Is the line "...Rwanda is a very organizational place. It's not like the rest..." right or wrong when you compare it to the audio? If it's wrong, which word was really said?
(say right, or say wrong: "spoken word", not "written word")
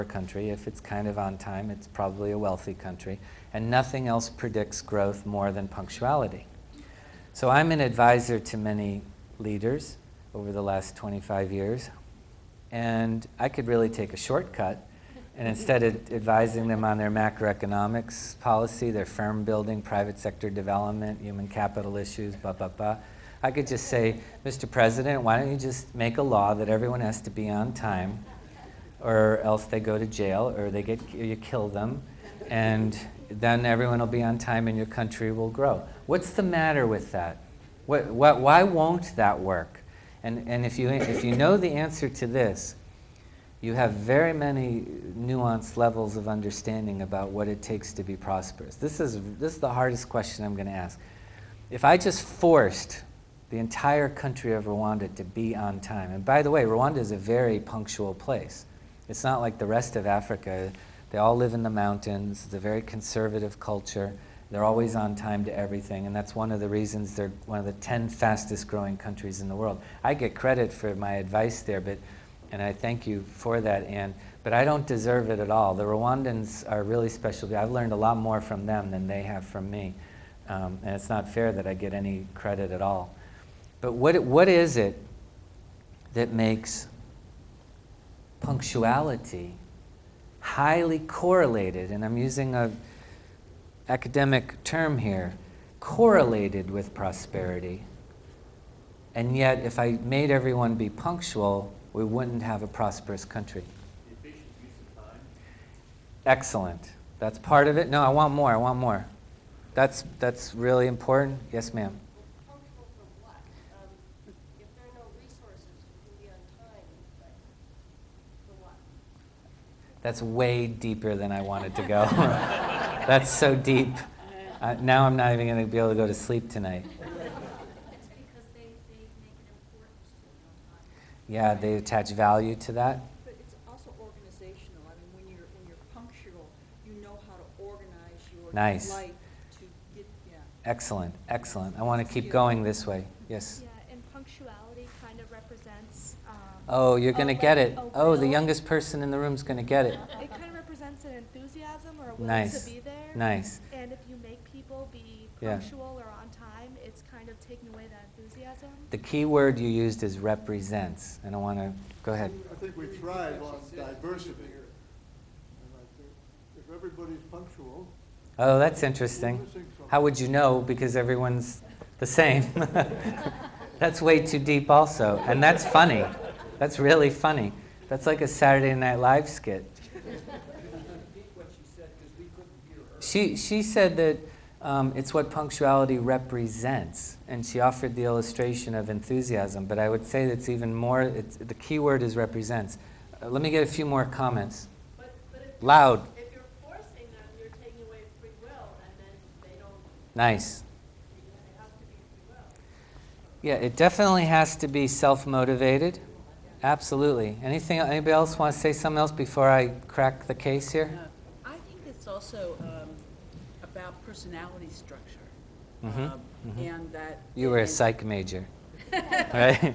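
wrong: "punctual", not "organizational".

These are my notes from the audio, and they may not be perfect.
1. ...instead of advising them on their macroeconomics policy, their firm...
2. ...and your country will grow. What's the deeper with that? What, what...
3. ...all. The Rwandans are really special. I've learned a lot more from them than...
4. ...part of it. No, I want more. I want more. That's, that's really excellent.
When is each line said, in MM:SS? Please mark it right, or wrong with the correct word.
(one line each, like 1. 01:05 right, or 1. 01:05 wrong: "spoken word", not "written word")
1. 00:15 right
2. 00:34 wrong: "matter", not "deeper"
3. 01:15 right
4. 01:47 wrong: "important", not "excellent".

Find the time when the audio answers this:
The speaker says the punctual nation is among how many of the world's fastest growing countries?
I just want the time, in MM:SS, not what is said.
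01:07.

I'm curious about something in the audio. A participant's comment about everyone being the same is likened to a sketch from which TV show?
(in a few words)
Saturday Night Live.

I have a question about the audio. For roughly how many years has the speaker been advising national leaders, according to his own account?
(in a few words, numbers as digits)
25 years.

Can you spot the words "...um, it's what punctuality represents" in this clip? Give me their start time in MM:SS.
03:04.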